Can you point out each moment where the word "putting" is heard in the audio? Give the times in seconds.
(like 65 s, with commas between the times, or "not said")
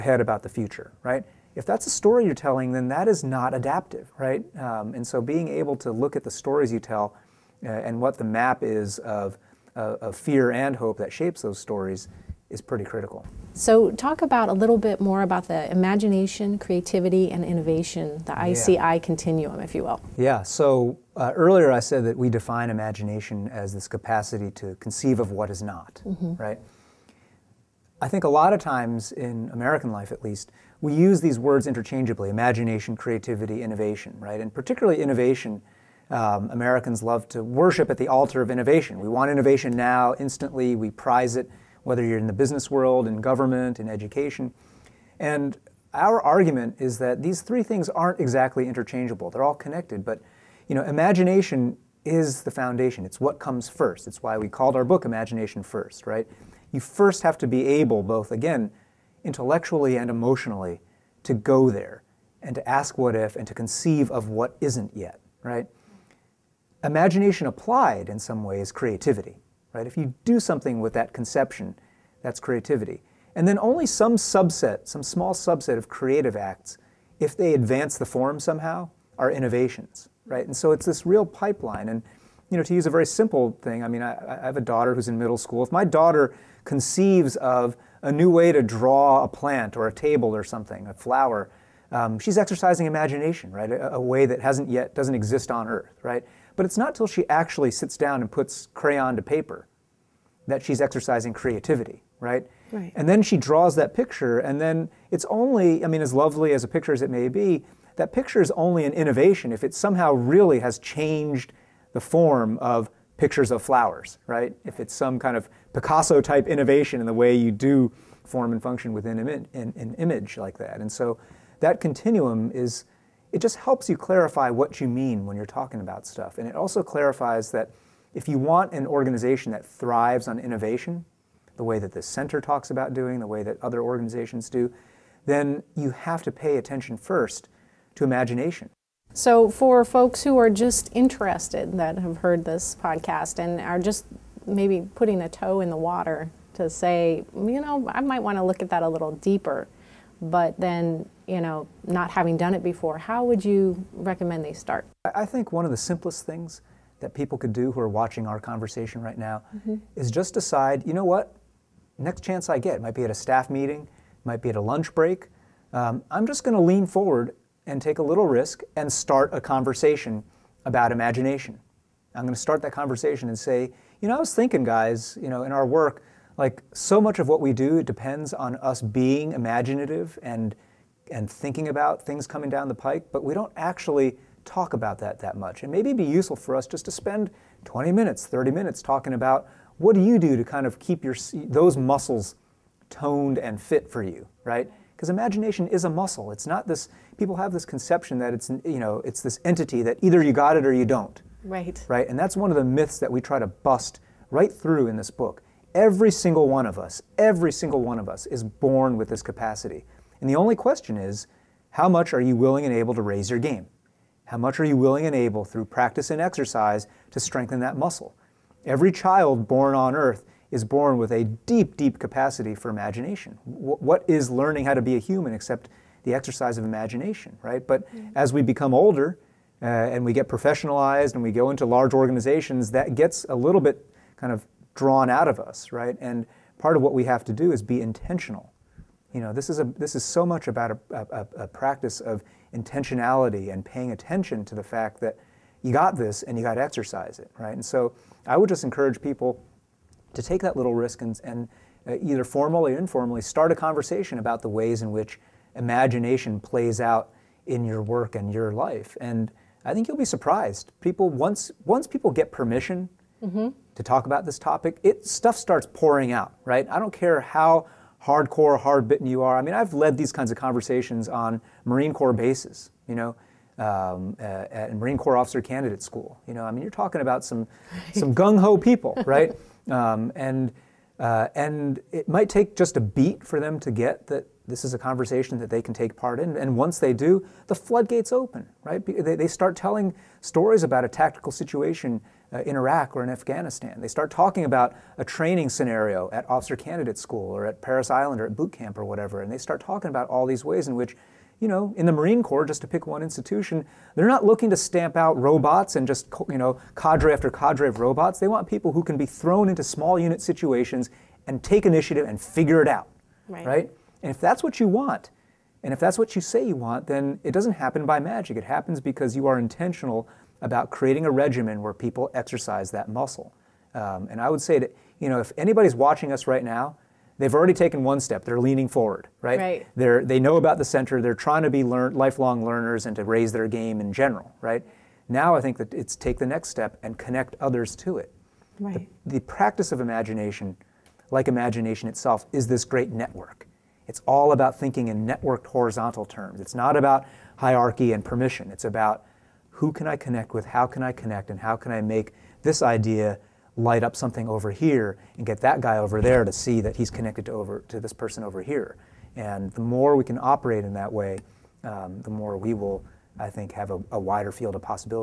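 144 s.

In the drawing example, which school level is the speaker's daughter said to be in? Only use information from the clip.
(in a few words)
Middle school.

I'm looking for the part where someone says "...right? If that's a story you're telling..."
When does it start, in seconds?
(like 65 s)
1 s.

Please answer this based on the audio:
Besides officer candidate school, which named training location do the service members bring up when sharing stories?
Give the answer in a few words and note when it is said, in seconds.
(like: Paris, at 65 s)
Parris Island, at 297 s.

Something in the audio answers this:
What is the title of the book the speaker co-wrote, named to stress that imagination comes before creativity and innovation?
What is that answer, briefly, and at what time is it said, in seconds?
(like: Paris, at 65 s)
Imagination First, at 55 s.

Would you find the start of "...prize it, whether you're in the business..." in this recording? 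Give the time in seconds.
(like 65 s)
40 s.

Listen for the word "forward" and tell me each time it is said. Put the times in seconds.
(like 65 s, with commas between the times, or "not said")
166 s, 328 s.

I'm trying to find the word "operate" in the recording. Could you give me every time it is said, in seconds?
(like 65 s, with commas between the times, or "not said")
360 s.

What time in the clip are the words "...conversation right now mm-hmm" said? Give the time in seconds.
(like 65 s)
158 s.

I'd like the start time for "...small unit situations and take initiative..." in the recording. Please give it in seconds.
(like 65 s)
309 s.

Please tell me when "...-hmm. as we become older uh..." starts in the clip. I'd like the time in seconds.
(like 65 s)
227 s.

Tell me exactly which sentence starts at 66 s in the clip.
Imagination applied in some ways creativity, right?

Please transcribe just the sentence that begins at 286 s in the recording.
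And once they do, the floodgates open, right?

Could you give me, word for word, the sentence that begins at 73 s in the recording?
And then only some subset, some small subset of creative acts, if they advance the form somehow, are innovations, right?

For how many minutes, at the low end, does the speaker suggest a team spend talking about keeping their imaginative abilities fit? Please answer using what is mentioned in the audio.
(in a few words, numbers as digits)
20 minutes.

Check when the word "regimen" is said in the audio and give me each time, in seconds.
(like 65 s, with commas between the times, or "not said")
321 s.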